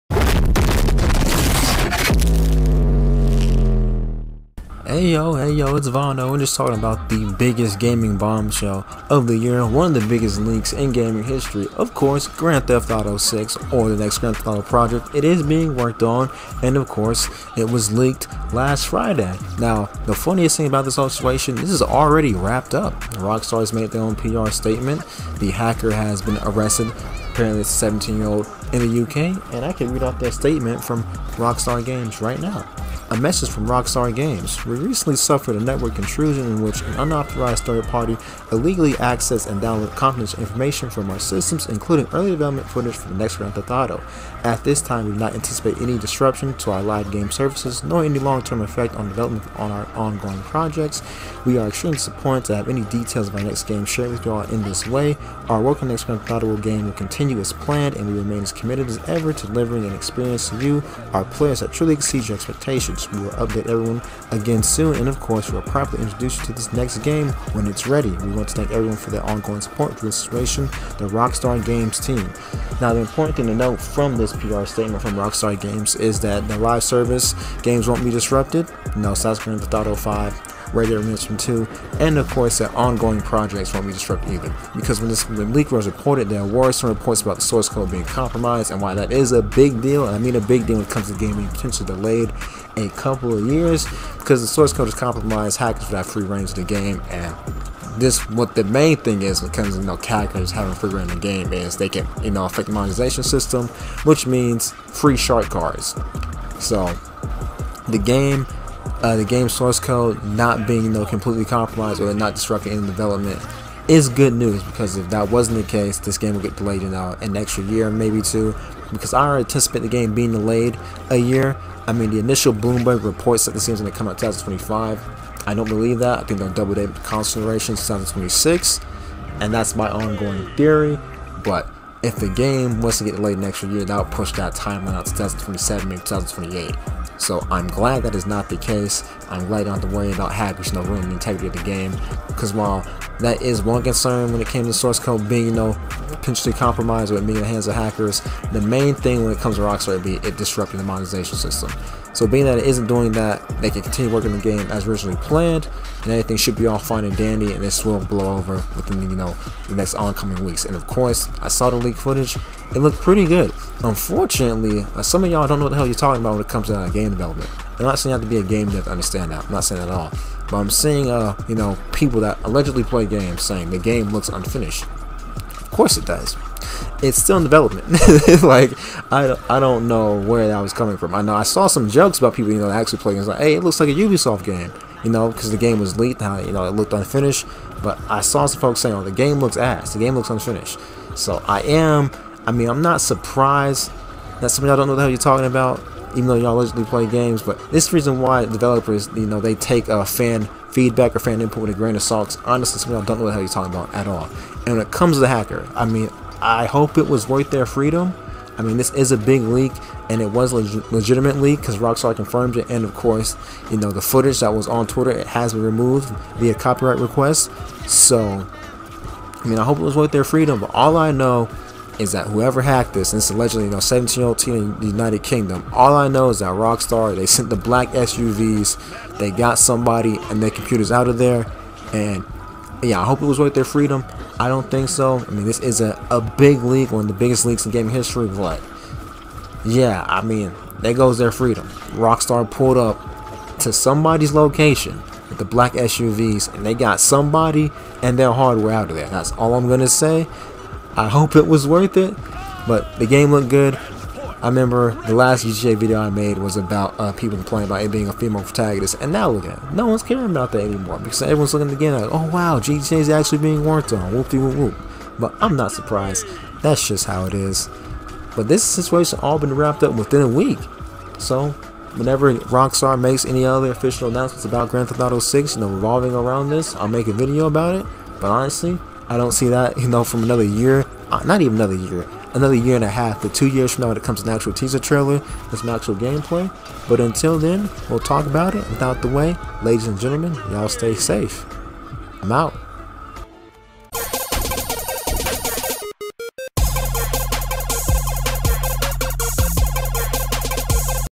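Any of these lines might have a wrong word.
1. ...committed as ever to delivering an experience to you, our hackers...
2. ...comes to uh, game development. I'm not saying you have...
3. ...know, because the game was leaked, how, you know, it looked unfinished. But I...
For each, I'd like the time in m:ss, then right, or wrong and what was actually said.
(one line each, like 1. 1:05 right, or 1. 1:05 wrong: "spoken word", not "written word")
1. 0:58 wrong: "players", not "hackers"
2. 2:46 right
3. 3:05 right.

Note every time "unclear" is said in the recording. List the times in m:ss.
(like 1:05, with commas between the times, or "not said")
not said.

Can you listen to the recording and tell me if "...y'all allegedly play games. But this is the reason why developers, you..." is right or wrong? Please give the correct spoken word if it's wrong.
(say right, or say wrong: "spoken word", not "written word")
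right.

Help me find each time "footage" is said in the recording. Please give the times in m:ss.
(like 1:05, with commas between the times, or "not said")
0:42, 2:41, 3:34.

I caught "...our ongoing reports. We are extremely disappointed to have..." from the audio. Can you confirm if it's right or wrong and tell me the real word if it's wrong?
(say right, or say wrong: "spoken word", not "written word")
wrong: "projects", not "reports".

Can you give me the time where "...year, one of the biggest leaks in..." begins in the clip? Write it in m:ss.
0:09.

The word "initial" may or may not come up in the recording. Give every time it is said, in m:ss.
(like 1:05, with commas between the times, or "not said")
2:02.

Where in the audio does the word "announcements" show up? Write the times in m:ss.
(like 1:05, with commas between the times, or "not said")
4:34.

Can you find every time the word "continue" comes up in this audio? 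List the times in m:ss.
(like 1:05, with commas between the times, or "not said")
0:56, 2:33.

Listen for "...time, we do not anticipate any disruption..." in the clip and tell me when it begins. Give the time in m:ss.
0:44.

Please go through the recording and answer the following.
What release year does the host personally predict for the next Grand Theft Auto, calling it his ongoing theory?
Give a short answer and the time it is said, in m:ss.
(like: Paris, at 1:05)
2026, at 2:07.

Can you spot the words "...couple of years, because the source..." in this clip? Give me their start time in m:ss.
1:32.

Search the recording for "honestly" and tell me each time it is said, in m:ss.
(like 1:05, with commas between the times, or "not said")
3:22, 4:38.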